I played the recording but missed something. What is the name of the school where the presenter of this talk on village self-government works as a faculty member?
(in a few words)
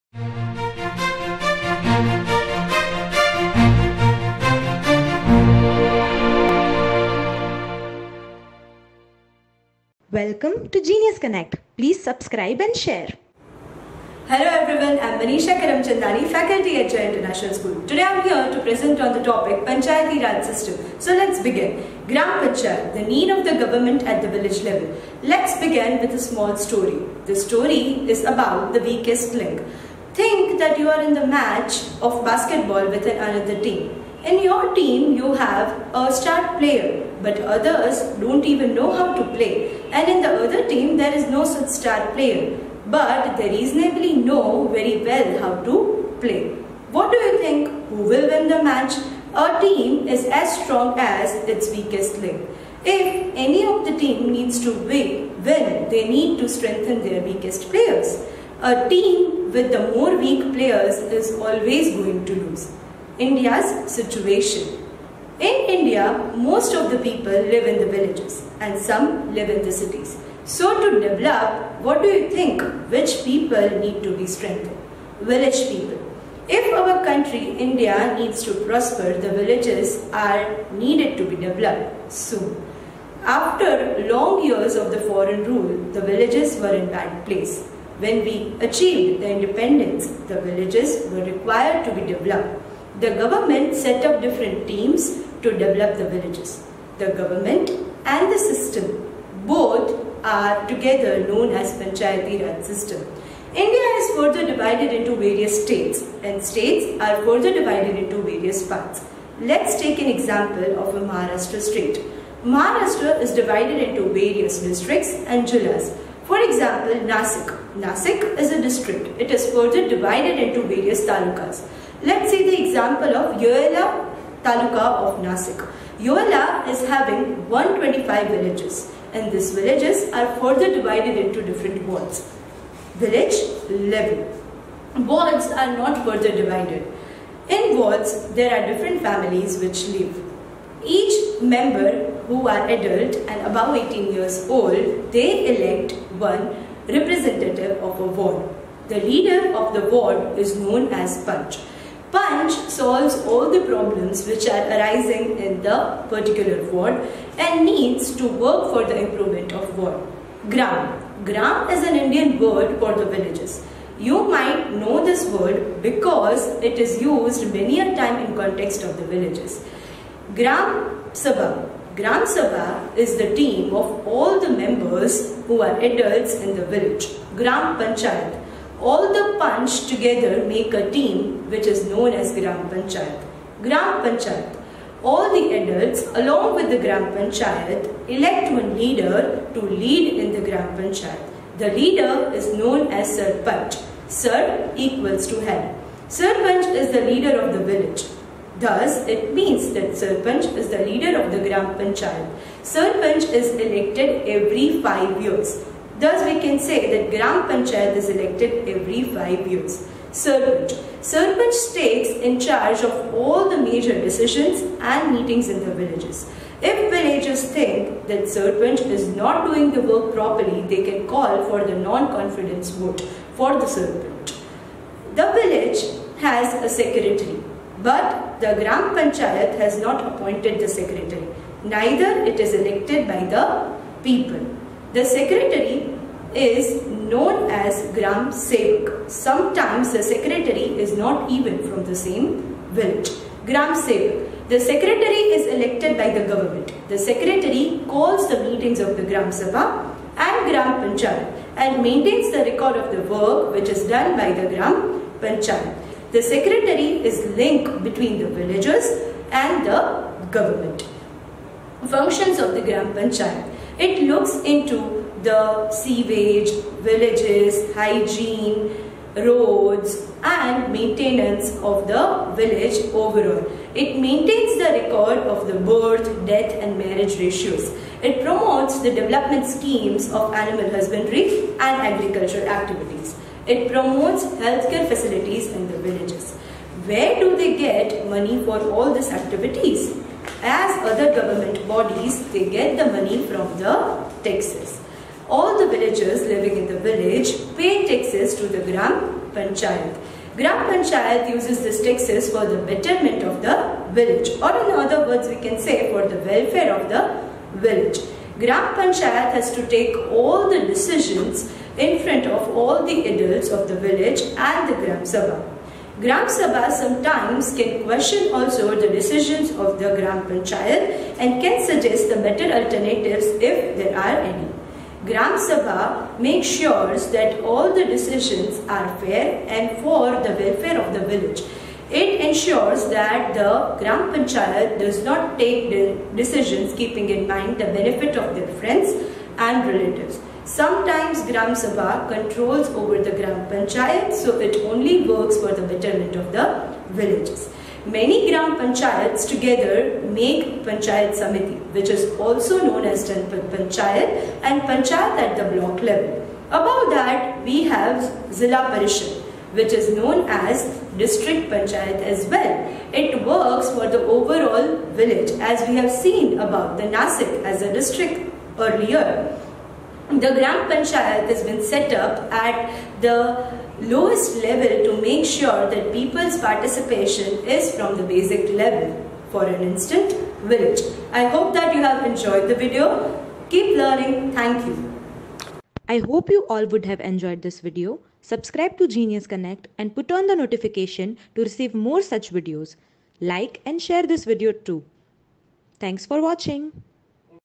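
Jay International School.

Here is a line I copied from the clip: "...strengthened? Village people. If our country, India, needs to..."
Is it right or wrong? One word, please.
right.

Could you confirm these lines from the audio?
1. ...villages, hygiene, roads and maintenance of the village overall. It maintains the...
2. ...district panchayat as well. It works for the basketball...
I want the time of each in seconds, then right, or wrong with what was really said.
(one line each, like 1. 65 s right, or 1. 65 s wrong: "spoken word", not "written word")
1. 266 s right
2. 360 s wrong: "overall", not "basketball".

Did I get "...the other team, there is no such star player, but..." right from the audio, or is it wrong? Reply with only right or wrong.
right.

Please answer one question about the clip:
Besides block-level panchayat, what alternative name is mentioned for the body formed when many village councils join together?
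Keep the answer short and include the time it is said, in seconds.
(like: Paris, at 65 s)
Janpad Panchayat, at 353 s.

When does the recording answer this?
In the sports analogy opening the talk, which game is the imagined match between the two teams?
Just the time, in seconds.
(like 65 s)
32 s.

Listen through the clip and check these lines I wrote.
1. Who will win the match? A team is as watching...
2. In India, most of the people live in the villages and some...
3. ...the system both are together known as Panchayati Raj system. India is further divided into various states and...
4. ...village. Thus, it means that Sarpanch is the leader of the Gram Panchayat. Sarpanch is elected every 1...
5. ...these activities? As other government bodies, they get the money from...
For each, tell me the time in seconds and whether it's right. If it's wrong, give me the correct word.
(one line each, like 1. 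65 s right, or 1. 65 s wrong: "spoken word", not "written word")
1. 47 s wrong: "strong", not "watching"
2. 65 s right
3. 98 s right
4. 197 s wrong: "5", not "1"
5. 288 s right.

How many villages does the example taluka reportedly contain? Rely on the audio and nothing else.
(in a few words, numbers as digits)
125.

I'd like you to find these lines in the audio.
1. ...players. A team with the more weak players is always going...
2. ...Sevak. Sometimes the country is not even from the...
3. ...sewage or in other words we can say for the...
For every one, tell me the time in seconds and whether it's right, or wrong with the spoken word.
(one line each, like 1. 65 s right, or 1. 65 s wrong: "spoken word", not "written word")
1. 57 s right
2. 238 s wrong: "secretary", not "country"
3. 303 s wrong: "village", not "sewage".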